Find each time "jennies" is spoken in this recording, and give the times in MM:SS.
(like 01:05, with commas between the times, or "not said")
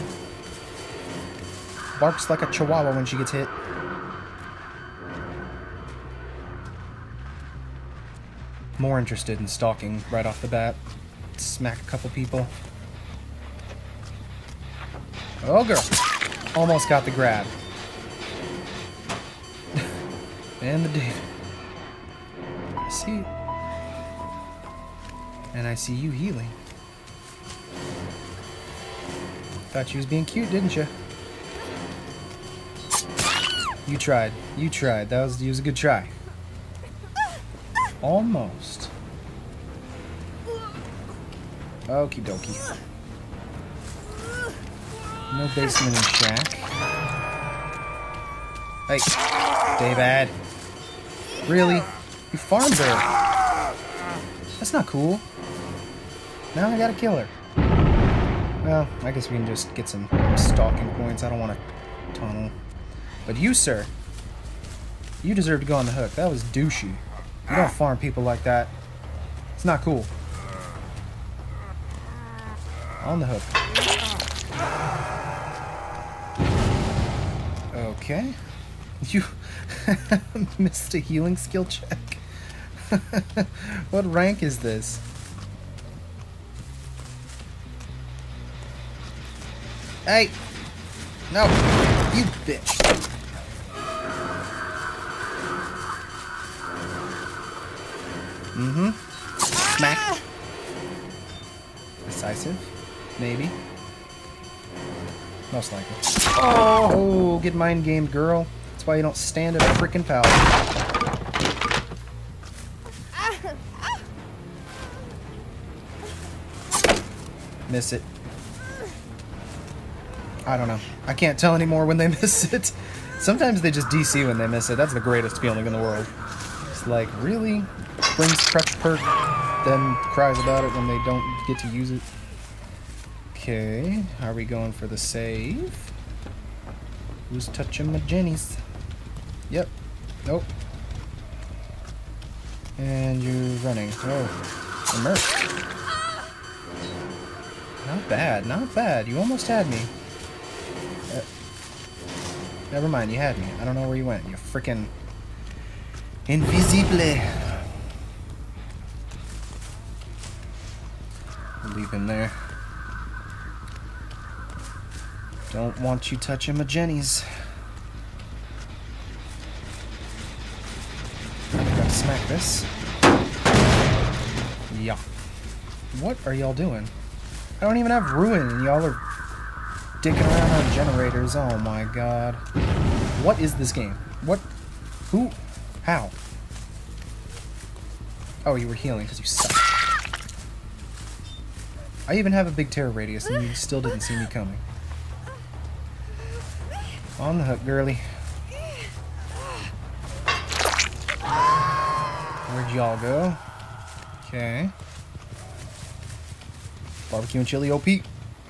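02:17, 02:46.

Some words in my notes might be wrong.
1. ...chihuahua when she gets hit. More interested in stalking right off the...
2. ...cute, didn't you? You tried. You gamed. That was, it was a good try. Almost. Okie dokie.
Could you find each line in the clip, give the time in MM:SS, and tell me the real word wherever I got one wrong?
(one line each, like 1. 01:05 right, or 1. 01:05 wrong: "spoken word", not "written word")
1. 00:02 right
2. 00:30 wrong: "tried", not "gamed".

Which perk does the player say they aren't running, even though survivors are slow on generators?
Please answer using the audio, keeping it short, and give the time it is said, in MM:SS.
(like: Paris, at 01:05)
Ruin, at 02:58.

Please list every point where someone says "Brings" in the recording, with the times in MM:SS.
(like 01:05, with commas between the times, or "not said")
02:08.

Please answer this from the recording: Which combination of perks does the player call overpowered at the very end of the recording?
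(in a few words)
Barbecue and chili.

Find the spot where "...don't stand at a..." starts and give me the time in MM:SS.
01:49.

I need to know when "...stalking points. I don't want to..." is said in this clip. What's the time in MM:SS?
01:00.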